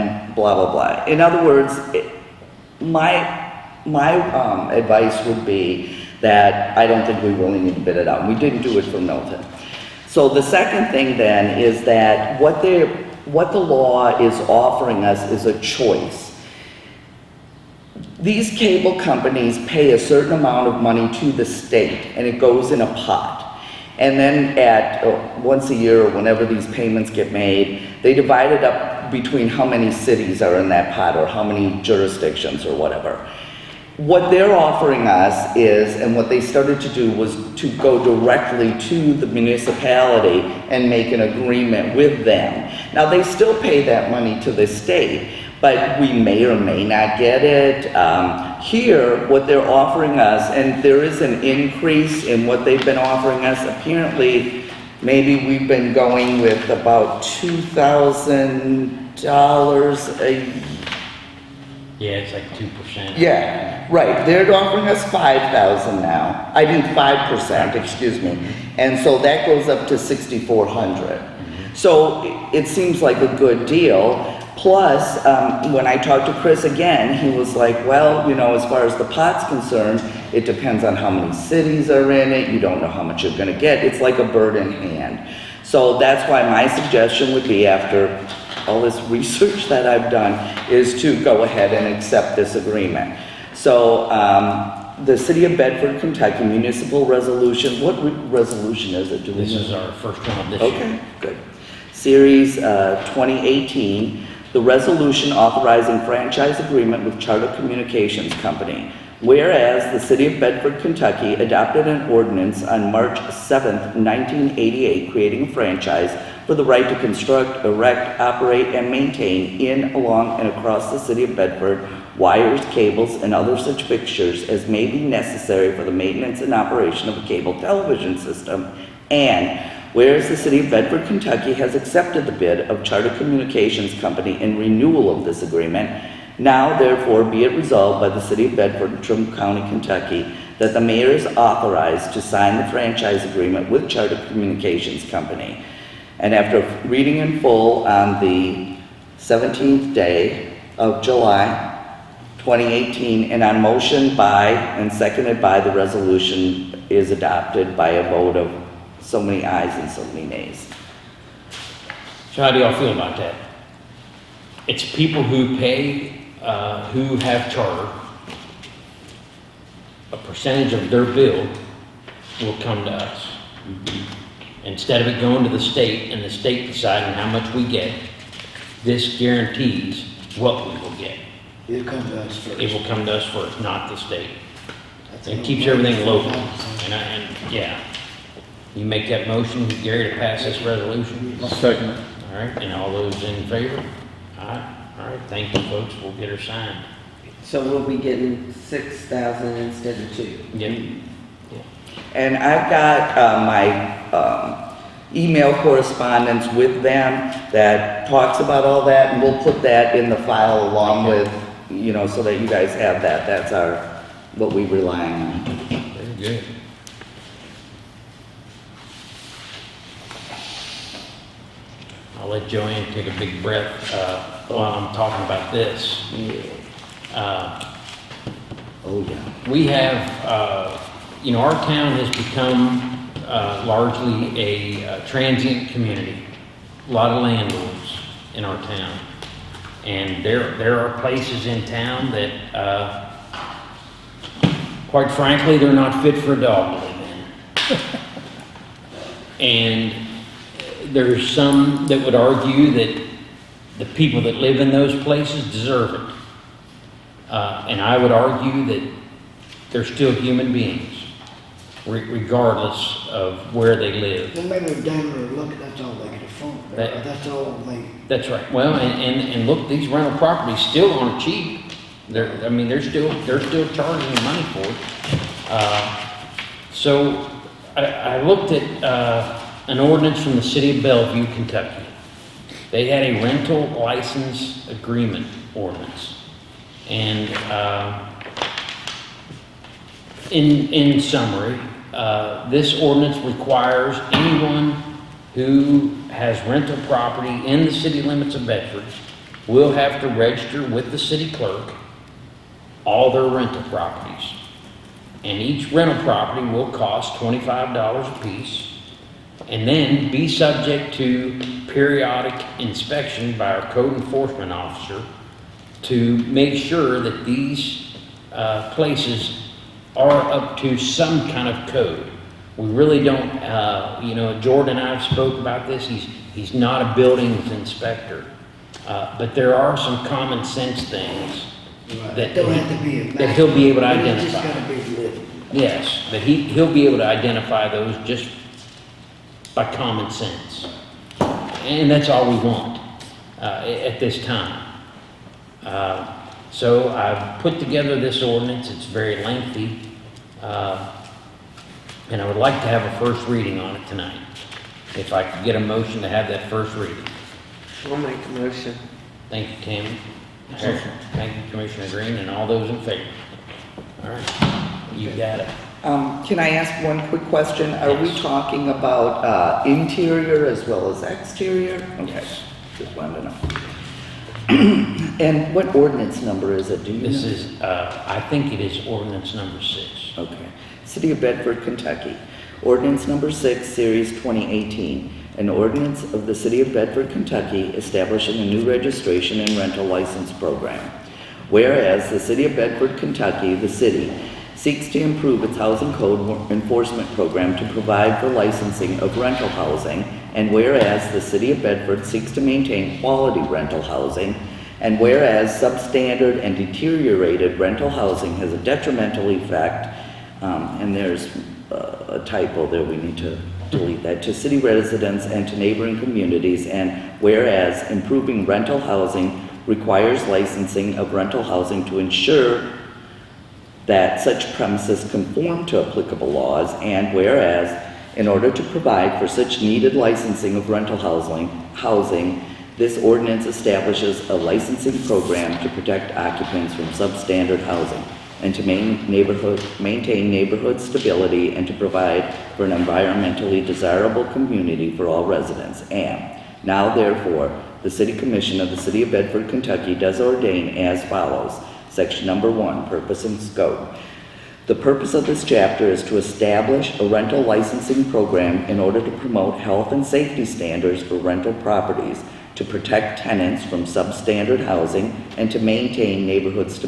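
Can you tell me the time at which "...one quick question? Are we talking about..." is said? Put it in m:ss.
6:06.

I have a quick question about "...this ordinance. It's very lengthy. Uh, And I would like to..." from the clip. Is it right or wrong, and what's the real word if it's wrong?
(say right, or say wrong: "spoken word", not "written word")
right.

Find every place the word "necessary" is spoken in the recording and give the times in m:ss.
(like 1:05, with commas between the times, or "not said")
2:05.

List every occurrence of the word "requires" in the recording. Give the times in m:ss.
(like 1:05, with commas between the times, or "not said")
4:53, 6:59.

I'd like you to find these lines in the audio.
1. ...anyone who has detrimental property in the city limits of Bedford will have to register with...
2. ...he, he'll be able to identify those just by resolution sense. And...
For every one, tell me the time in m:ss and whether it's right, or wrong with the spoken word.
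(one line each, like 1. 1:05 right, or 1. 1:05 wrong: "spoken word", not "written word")
1. 4:54 wrong: "rental", not "detrimental"
2. 5:36 wrong: "common", not "resolution".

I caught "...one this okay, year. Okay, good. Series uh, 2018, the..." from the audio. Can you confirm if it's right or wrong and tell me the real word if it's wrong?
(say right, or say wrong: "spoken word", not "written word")
right.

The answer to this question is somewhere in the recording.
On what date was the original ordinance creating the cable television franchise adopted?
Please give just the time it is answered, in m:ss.
1:52.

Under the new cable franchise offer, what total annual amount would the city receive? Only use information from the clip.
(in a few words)
$6,400.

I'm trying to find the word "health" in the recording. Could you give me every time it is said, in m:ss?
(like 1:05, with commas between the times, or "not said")
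7:39.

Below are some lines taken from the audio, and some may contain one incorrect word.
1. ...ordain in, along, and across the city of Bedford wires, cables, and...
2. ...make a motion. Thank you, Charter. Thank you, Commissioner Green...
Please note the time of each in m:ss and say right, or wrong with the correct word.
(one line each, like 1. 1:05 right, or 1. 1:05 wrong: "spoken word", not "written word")
1. 1:58 wrong: "maintain", not "ordain"
2. 5:57 wrong: "Tammy", not "Charter".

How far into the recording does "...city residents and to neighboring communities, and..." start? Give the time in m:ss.
6:54.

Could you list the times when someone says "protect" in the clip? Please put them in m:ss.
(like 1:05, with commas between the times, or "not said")
7:15, 7:42.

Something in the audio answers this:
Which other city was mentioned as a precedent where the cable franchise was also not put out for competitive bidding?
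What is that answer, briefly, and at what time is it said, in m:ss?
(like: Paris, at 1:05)
Milton, at 0:09.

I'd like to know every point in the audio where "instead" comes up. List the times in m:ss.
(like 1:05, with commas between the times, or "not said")
2:54, 3:19.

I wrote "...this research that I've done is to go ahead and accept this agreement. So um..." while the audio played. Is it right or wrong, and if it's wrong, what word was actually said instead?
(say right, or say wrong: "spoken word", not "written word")
right.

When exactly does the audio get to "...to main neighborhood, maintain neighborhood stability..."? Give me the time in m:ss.
7:18.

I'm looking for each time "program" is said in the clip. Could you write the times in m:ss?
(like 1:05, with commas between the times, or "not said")
6:30, 6:37, 7:15, 7:38.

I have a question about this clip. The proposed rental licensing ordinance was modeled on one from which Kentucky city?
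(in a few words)
Bellevue.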